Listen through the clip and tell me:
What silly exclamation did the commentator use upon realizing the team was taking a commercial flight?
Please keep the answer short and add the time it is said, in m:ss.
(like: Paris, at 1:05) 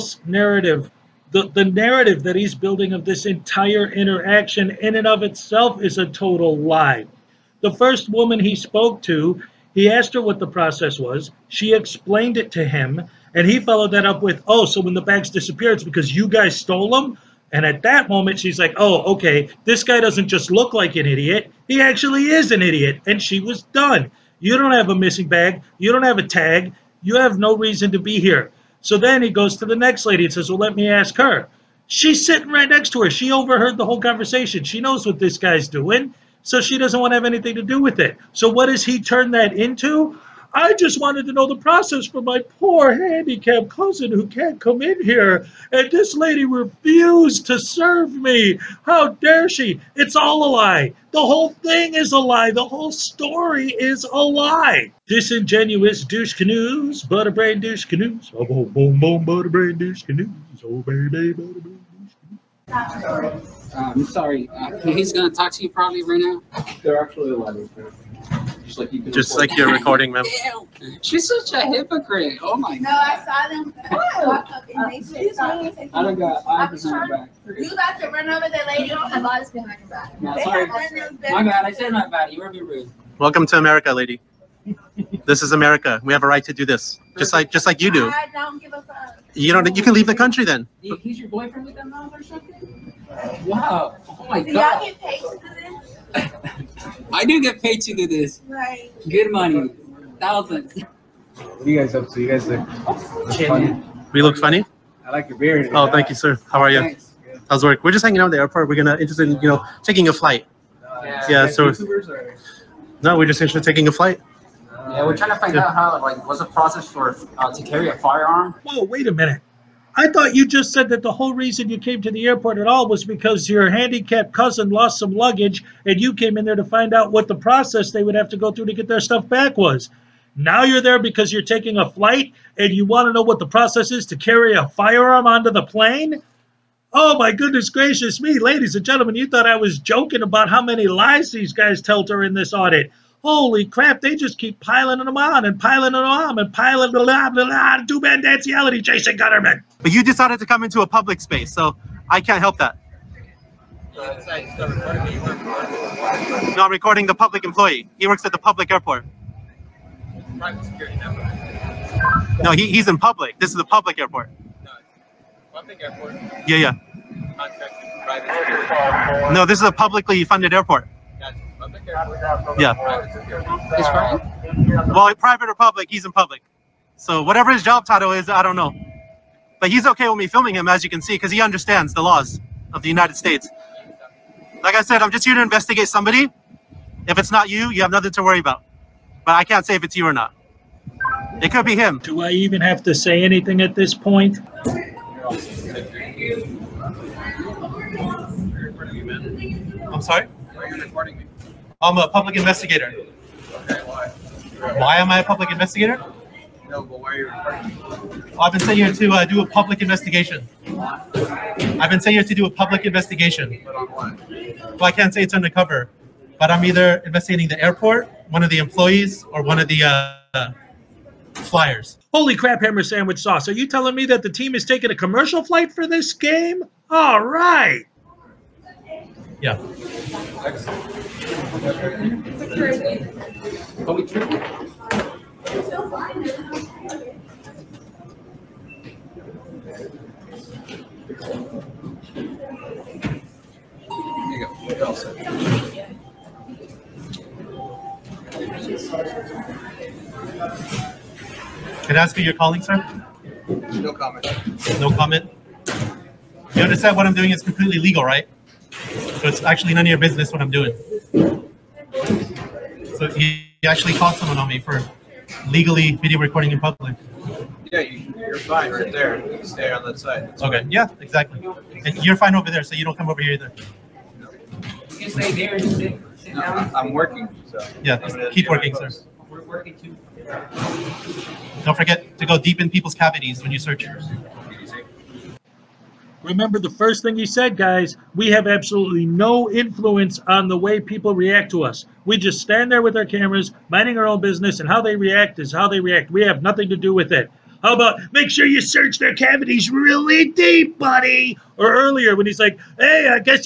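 Hammer Sandwich Sauce, at 3:42.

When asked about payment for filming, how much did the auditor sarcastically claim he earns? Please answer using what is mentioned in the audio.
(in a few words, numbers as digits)
Thousands.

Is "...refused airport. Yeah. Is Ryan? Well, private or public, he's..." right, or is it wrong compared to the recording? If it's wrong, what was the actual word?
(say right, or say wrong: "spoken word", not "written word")
wrong: "funded", not "refused".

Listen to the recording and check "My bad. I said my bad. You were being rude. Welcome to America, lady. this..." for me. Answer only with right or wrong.
right.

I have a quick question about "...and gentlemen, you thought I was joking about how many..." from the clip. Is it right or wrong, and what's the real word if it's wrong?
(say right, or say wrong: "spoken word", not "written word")
right.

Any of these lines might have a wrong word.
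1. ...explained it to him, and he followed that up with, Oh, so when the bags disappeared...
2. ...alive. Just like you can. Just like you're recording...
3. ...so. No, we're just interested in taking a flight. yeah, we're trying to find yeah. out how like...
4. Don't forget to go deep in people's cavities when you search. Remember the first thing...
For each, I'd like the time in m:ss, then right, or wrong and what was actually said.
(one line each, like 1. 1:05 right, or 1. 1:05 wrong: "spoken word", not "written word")
1. 0:11 right
2. 1:07 right
3. 1:51 right
4. 4:41 right.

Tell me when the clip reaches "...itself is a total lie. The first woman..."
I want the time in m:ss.
0:05.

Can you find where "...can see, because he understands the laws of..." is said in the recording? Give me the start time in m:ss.
3:00.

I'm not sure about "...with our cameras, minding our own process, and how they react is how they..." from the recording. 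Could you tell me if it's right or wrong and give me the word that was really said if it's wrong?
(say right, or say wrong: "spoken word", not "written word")
wrong: "business", not "process".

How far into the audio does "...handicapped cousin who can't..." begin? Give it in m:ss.
0:42.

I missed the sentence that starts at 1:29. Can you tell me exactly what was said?
You can leave the country then.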